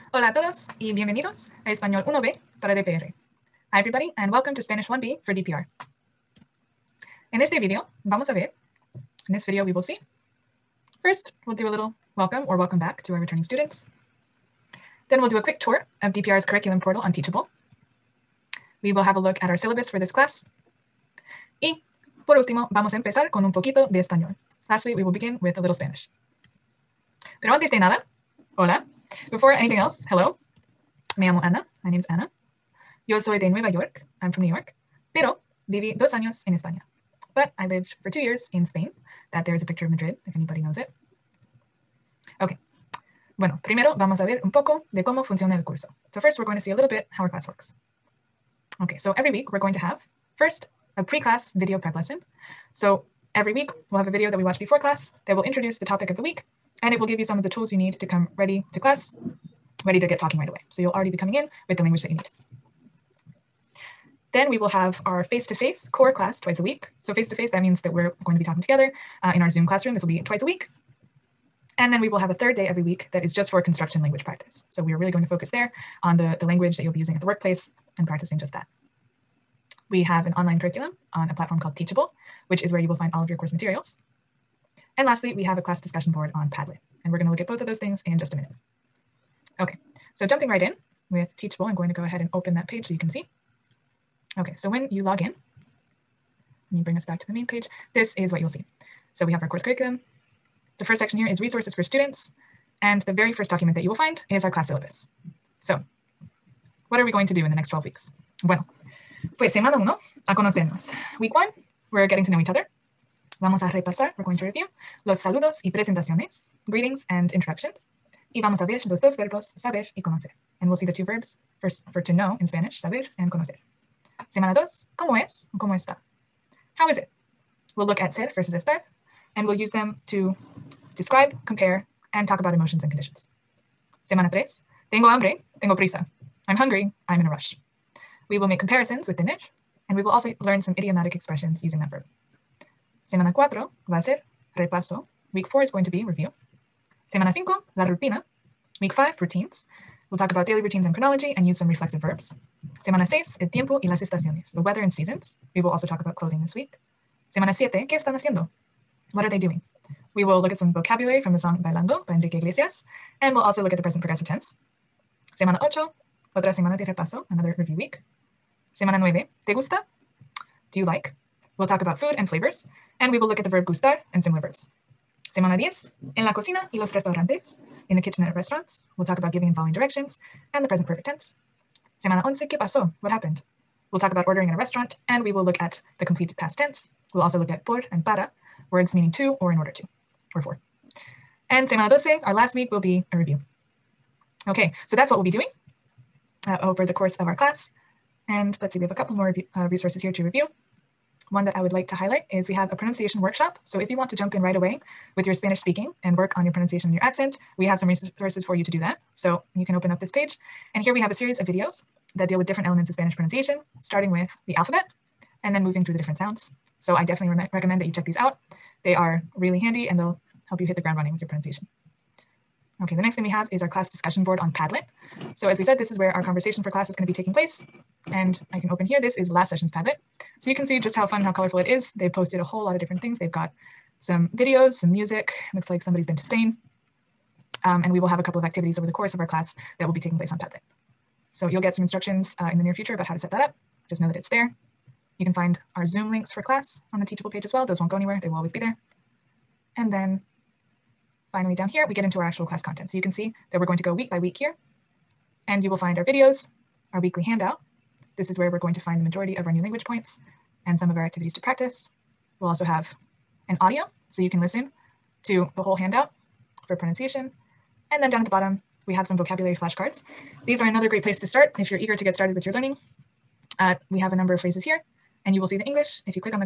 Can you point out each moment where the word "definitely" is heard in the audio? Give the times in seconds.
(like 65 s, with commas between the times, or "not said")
217 s.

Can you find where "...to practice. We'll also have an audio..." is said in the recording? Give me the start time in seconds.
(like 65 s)
261 s.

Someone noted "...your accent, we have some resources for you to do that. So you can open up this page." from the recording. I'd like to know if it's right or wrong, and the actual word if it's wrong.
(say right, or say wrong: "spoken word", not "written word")
right.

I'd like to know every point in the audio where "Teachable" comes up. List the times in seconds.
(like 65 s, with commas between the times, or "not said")
17 s, 81 s, 91 s, 247 s.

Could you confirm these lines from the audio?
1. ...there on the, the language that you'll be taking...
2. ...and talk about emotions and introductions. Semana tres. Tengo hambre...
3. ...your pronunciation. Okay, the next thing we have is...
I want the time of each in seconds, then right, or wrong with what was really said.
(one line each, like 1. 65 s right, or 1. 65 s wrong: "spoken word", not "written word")
1. 75 s wrong: "using", not "taking"
2. 132 s wrong: "conditions", not "introductions"
3. 221 s right.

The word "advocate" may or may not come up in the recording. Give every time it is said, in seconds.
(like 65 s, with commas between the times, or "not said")
not said.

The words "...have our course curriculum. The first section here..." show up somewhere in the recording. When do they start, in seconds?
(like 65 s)
99 s.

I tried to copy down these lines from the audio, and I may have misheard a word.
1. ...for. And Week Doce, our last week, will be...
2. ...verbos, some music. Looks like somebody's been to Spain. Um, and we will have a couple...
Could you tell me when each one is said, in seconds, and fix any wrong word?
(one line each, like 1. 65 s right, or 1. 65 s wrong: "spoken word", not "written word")
1. 190 s wrong: "Semana", not "Week"
2. 234 s wrong: "videos", not "verbos".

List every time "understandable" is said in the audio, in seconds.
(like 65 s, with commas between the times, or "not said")
not said.